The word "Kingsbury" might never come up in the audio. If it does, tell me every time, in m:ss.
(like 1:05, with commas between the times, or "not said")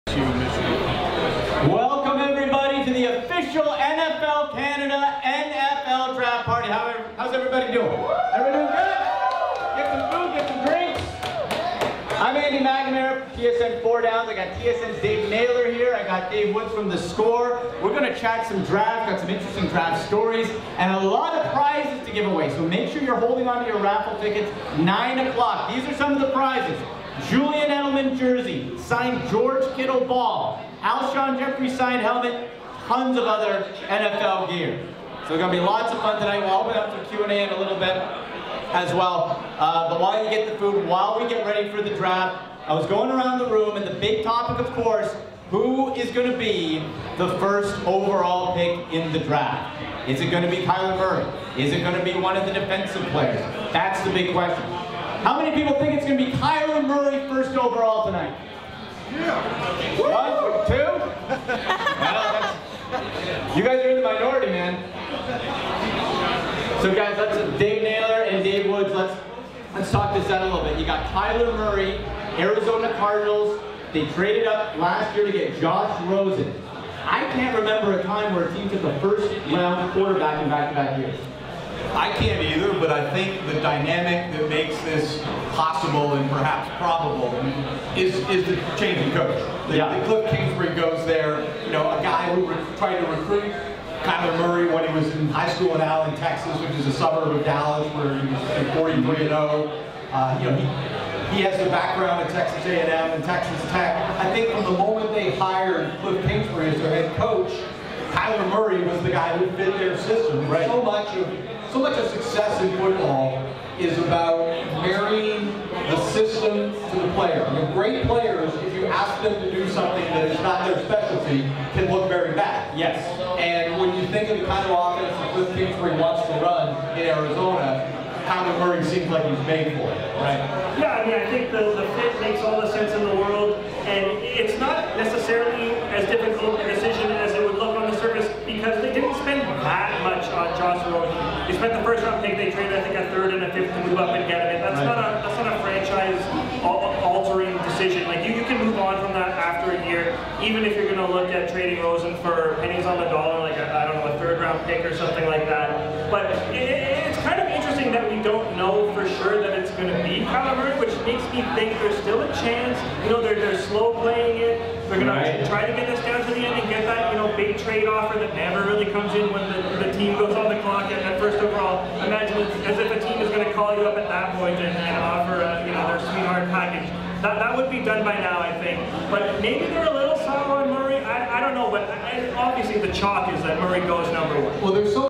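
1:30, 2:05.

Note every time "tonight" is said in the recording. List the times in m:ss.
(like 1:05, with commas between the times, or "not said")
0:36, 0:58.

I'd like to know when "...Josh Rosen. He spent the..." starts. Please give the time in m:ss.
2:20.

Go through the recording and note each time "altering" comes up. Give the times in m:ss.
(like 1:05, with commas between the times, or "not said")
2:27.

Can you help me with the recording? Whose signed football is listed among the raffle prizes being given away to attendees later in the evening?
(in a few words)
George Kittle.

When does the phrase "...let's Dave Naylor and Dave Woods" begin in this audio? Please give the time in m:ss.
1:07.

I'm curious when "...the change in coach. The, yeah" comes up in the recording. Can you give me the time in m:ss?
1:28.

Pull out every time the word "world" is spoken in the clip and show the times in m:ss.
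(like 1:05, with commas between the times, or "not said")
2:13.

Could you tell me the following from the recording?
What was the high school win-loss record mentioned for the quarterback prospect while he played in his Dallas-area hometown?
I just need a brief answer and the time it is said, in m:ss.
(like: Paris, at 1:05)
43-0, at 1:38.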